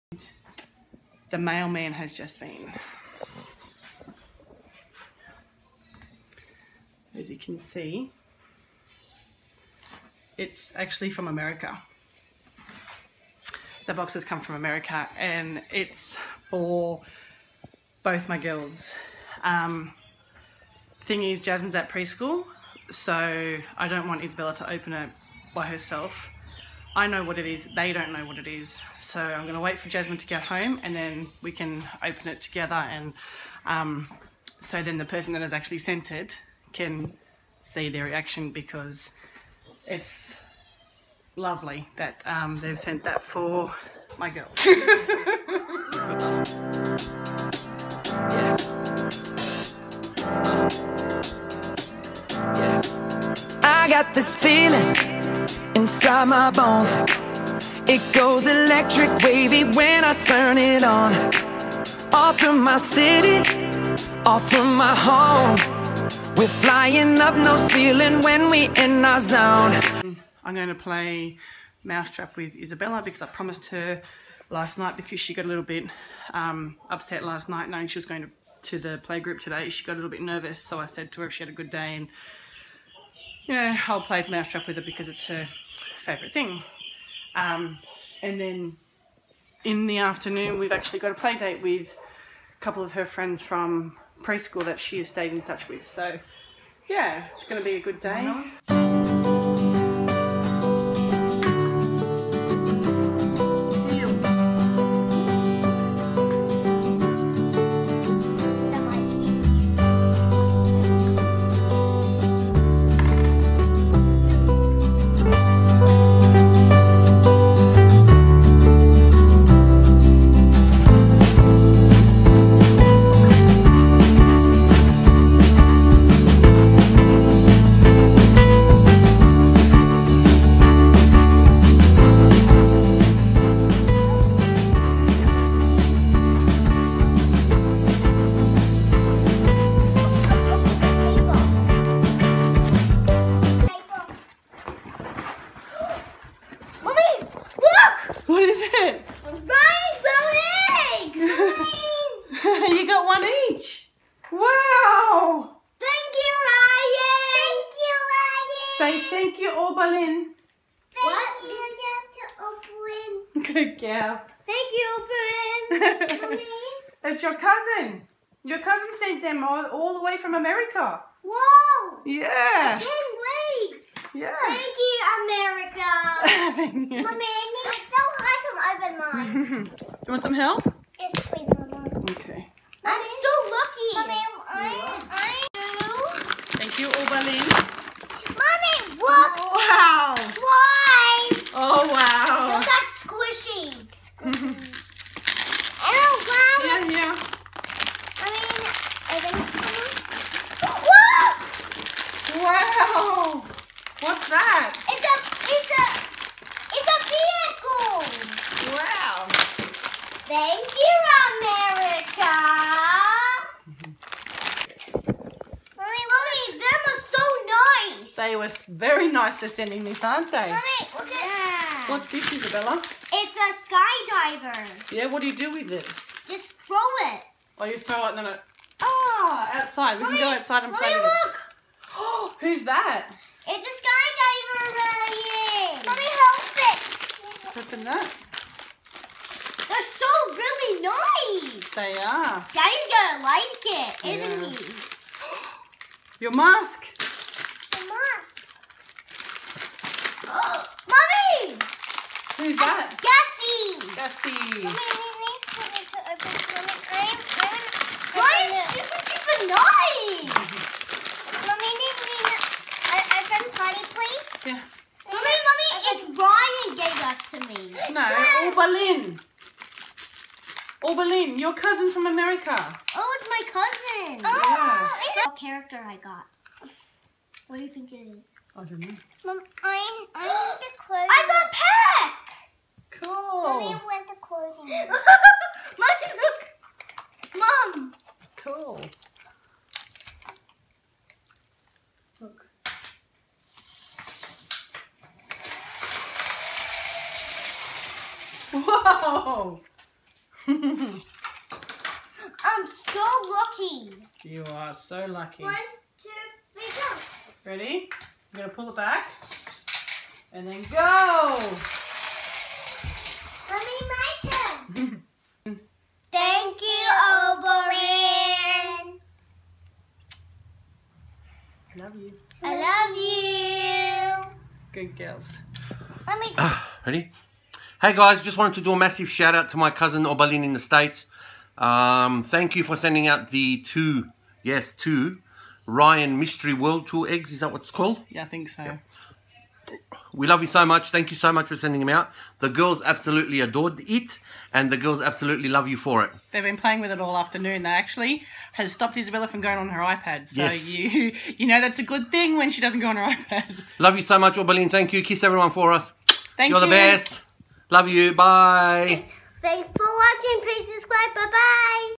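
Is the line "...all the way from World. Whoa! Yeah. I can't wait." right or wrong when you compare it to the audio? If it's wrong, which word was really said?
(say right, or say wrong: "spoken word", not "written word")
wrong: "America", not "World".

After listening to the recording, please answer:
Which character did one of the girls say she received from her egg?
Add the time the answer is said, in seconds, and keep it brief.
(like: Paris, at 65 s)
Peck, at 280 s.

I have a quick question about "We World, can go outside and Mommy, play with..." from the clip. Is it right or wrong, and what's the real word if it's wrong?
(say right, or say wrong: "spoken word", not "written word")
wrong: "Mommy", not "World".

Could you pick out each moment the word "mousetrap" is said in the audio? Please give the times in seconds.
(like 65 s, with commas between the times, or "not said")
71 s, 84 s.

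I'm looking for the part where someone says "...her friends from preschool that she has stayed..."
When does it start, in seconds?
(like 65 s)
92 s.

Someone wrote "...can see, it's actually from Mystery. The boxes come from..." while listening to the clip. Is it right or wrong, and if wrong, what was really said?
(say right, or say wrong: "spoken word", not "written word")
wrong: "America", not "Mystery".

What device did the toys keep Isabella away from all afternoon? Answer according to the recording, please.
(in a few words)
Her iPad.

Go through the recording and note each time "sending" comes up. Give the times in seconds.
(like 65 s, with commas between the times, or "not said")
219 s, 332 s, 341 s.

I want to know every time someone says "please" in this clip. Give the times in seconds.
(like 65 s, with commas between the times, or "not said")
181 s, 360 s.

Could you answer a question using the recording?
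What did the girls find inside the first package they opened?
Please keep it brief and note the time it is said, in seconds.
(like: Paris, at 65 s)
Rainbow eggs, at 149 s.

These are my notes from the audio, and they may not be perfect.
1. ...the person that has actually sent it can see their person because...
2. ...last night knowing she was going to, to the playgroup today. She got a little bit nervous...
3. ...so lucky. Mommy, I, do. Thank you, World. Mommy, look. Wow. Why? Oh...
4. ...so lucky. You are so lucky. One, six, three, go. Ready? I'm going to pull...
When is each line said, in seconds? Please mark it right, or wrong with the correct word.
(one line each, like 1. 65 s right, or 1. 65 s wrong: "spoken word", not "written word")
1. 34 s wrong: "reaction", not "person"
2. 77 s right
3. 183 s wrong: "Oberlin", not "World"
4. 302 s wrong: "two", not "six".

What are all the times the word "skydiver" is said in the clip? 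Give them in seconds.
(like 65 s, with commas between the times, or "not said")
223 s, 233 s.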